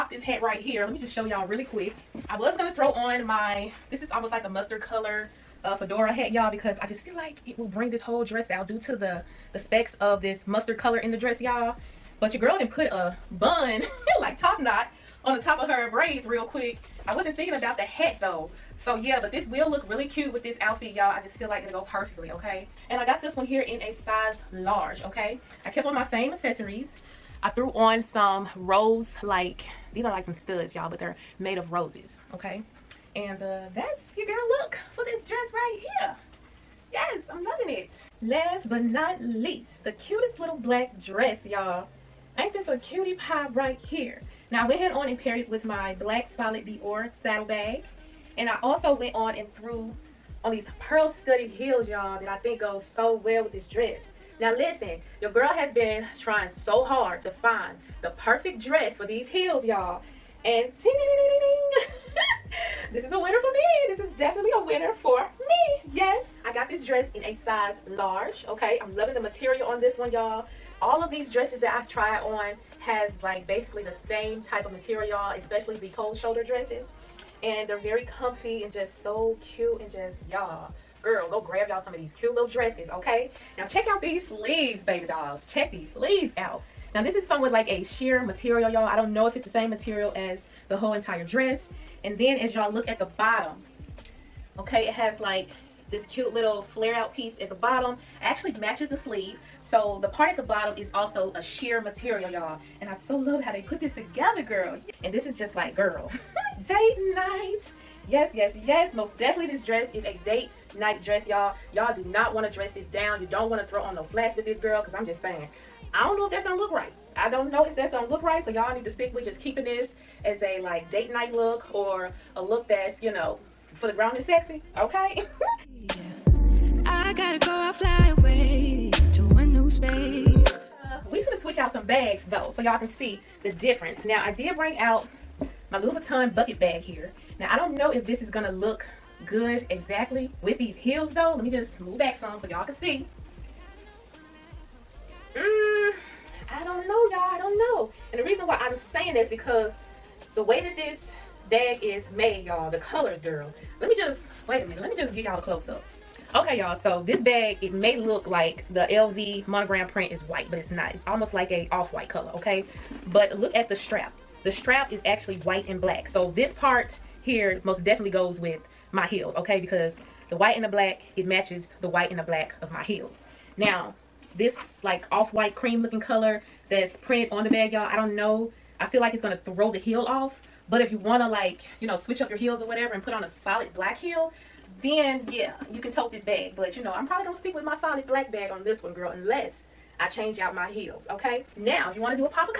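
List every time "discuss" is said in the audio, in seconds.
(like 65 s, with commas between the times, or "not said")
not said.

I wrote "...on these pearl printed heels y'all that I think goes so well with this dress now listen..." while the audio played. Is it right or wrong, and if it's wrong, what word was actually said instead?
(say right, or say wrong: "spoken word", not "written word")
wrong: "studded", not "printed".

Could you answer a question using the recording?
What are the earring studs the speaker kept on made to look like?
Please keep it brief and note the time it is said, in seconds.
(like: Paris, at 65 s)
Roses, at 31 s.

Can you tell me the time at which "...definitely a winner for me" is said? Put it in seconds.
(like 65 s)
64 s.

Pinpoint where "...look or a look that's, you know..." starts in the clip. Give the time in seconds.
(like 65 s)
121 s.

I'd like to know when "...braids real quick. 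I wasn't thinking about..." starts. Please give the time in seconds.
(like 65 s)
15 s.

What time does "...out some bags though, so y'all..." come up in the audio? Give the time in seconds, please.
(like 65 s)
131 s.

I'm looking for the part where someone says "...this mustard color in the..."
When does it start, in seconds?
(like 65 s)
10 s.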